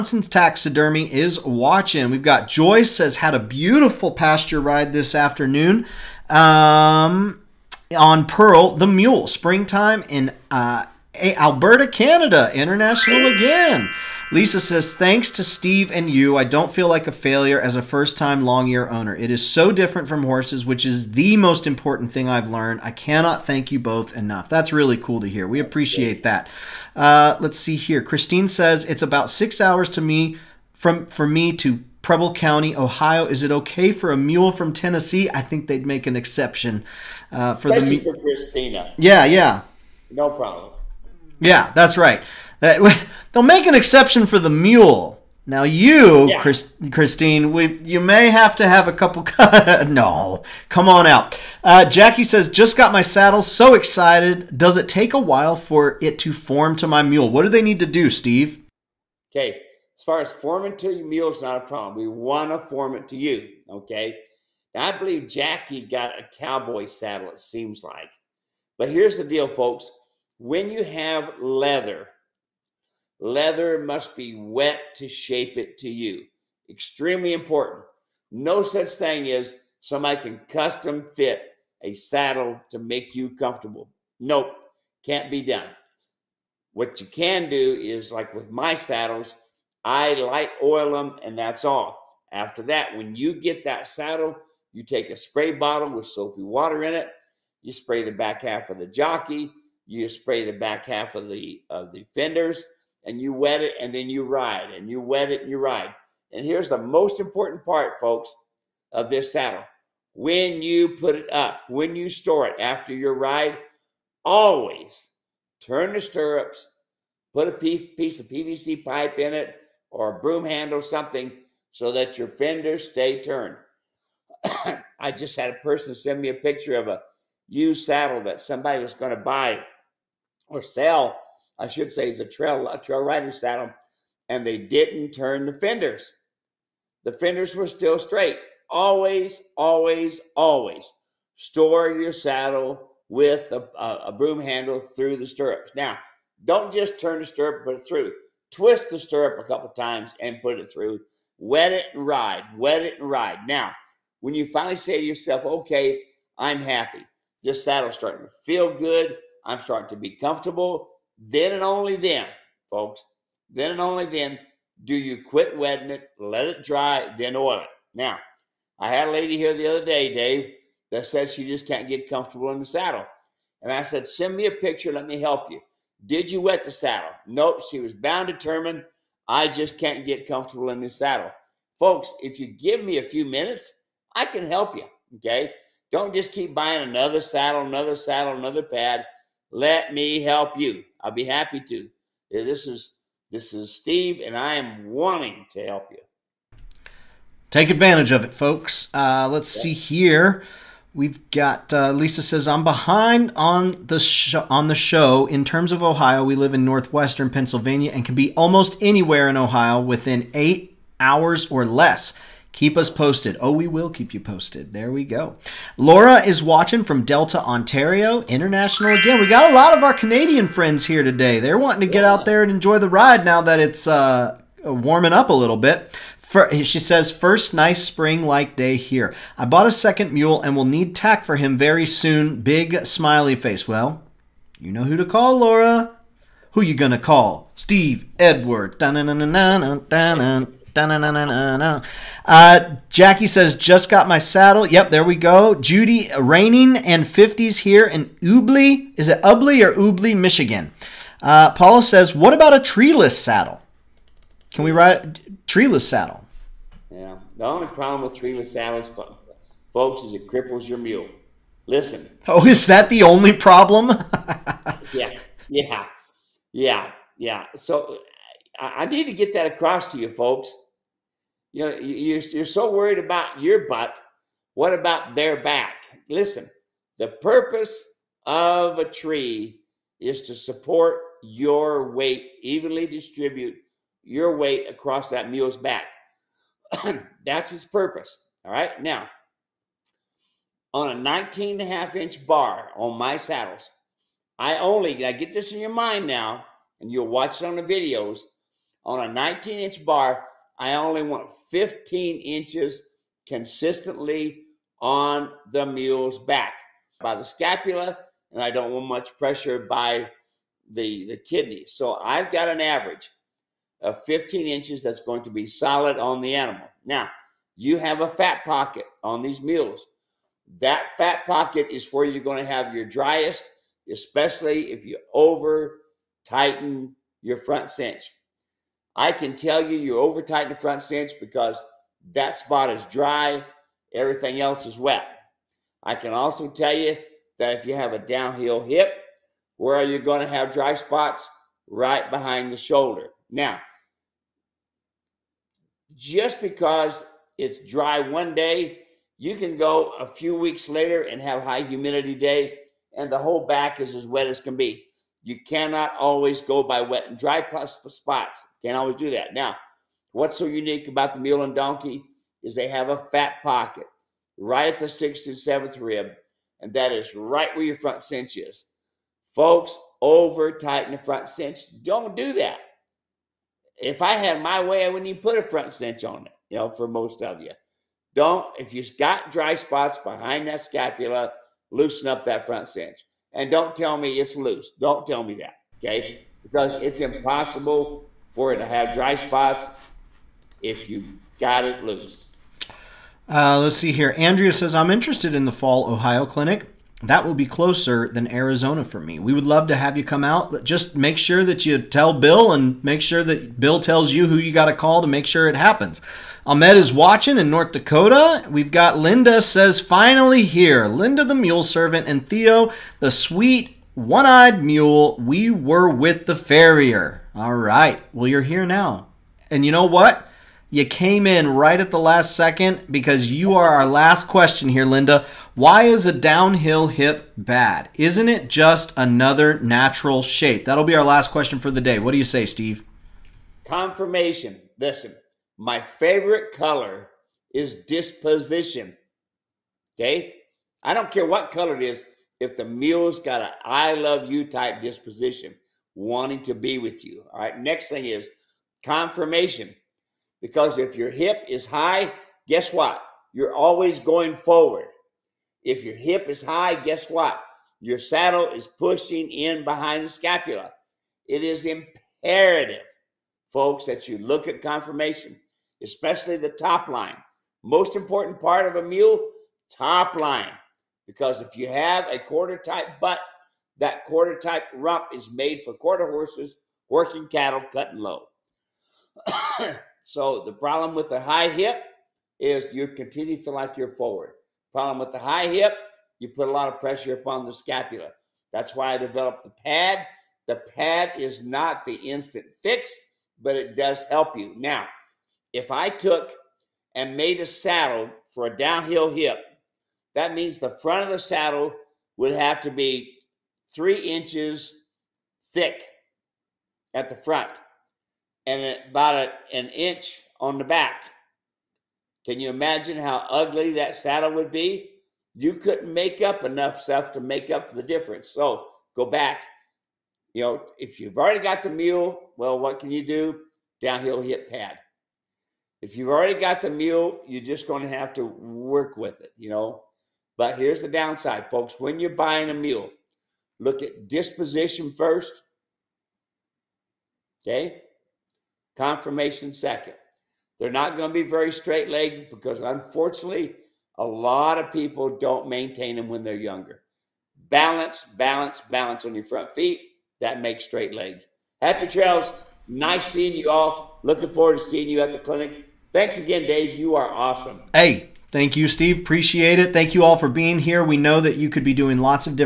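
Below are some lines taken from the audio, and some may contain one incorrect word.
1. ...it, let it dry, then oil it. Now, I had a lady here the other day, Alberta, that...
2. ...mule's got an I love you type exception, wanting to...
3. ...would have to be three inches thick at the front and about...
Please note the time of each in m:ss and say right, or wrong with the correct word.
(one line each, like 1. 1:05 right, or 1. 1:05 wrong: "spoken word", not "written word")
1. 2:45 wrong: "Dave", not "Alberta"
2. 7:22 wrong: "disposition", not "exception"
3. 8:22 right.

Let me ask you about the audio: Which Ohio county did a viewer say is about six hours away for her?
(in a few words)
Preble County.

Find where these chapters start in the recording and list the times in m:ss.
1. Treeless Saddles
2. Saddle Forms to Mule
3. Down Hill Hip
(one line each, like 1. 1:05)
1. 4:11
2. 0:51
3. 7:05.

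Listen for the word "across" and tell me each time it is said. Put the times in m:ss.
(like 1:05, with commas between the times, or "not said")
4:29, 4:44.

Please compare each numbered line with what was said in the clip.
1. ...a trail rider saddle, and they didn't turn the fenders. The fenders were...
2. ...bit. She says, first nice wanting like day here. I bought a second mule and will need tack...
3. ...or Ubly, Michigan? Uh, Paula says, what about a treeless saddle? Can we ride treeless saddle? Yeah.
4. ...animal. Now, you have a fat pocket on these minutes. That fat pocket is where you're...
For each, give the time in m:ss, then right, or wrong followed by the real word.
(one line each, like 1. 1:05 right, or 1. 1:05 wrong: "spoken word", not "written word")
1. 2:12 right
2. 3:45 wrong: "spring", not "wanting"
3. 4:09 right
4. 5:16 wrong: "mules", not "minutes".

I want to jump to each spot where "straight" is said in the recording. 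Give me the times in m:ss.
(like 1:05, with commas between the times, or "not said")
2:17, 9:01, 9:10.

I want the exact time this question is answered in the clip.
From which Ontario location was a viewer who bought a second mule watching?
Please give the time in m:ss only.
3:37.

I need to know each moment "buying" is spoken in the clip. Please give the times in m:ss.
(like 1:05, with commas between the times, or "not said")
3:06, 8:52.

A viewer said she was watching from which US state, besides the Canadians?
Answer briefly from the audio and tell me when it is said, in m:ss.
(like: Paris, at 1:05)
North Dakota, at 6:47.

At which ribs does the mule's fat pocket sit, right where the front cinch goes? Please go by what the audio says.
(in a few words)
Sixth and seventh.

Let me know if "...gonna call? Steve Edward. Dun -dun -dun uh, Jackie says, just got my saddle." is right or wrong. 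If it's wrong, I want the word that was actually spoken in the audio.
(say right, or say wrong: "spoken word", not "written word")
right.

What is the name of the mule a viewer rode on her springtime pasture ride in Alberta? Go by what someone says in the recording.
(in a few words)
Pearl.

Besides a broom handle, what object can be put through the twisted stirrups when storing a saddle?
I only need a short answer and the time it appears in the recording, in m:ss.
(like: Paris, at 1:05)
PVC pipe, at 1:58.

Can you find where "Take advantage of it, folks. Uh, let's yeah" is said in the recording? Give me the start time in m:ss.
3:17.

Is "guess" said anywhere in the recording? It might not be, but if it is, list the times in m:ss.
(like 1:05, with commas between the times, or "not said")
7:32, 7:36.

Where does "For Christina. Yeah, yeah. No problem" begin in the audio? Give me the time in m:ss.
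0:38.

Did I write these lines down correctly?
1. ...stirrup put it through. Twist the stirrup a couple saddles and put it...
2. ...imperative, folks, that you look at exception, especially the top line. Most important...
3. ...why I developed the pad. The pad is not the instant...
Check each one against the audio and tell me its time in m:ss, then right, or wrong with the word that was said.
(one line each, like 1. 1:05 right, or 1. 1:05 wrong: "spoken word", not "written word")
1. 2:27 wrong: "times", not "saddles"
2. 7:41 wrong: "conformation", not "exception"
3. 8:08 right.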